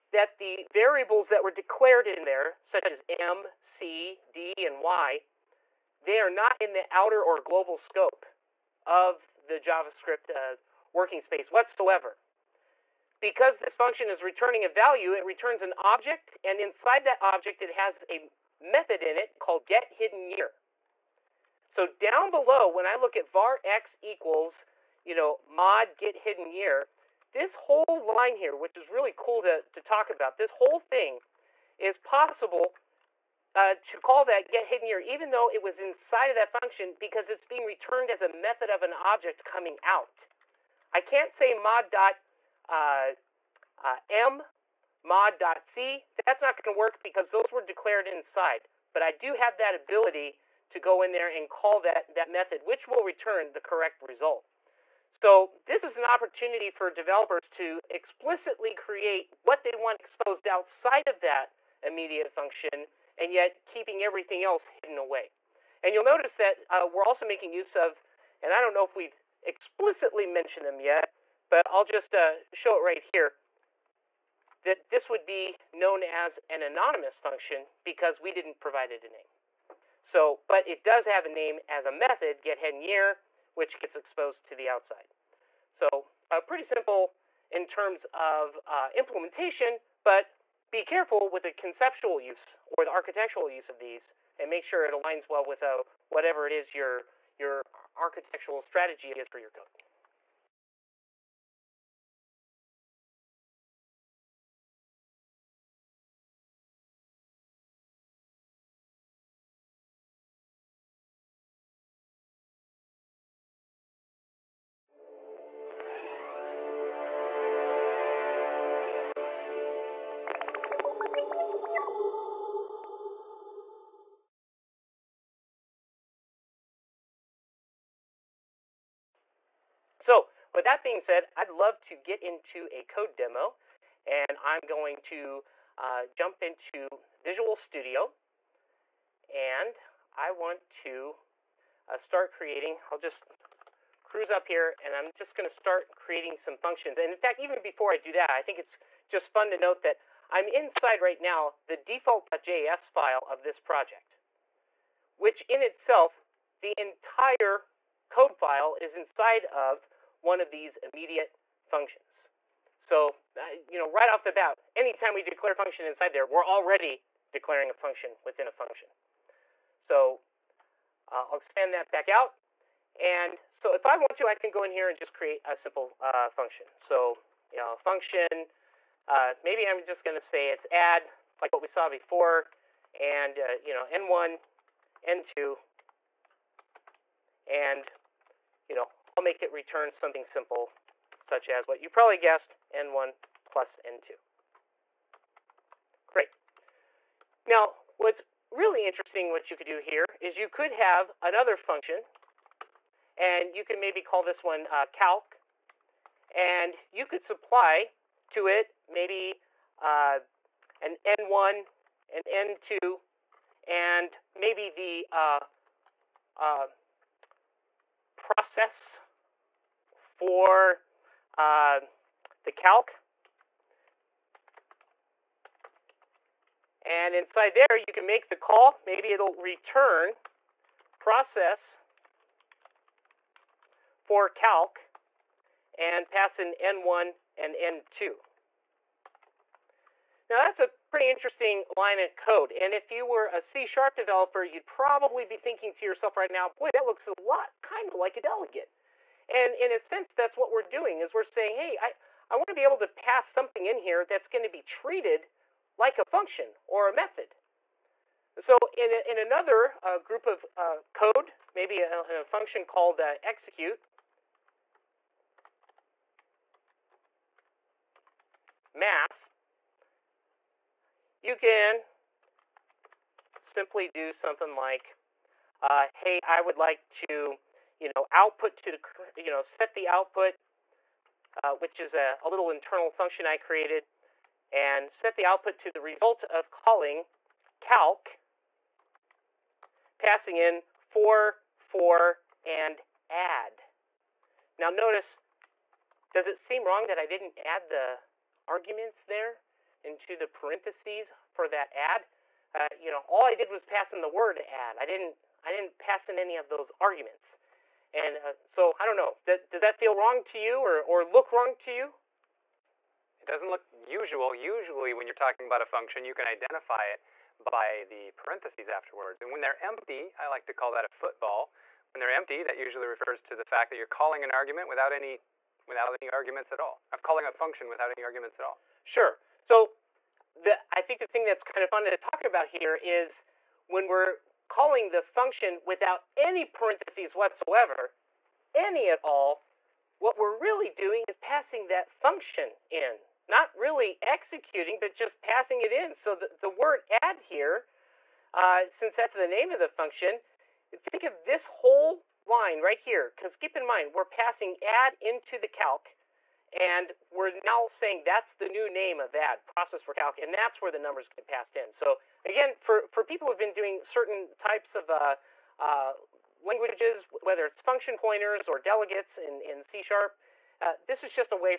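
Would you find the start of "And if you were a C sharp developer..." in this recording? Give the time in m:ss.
4:02.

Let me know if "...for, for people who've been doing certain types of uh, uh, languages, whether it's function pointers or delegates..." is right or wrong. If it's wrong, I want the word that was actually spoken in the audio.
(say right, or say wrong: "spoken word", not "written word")
right.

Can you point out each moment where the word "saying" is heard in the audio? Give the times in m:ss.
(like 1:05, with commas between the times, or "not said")
4:11, 5:57.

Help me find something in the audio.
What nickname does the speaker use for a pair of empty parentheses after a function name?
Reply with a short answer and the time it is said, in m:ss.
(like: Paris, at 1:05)
football, at 5:20.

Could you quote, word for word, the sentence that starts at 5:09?
does that feel wrong to you or, or look wrong to you?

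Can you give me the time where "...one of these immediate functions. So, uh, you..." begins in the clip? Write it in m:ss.
2:40.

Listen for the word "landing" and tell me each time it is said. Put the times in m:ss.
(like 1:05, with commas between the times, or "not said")
not said.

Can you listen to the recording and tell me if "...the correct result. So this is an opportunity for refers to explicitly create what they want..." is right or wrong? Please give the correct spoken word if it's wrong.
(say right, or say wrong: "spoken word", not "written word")
wrong: "developers", not "refers".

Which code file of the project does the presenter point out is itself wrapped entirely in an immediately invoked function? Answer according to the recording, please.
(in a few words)
default.js.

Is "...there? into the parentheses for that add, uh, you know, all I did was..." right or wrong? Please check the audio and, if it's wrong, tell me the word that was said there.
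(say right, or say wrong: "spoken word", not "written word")
right.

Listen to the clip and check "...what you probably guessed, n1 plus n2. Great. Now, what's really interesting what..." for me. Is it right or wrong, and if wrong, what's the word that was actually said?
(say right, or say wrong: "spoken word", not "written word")
right.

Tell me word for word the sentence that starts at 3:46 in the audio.
And inside there, you can make the call.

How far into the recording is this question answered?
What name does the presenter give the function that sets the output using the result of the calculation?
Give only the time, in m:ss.
4:23.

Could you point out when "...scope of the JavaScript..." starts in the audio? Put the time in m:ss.
0:07.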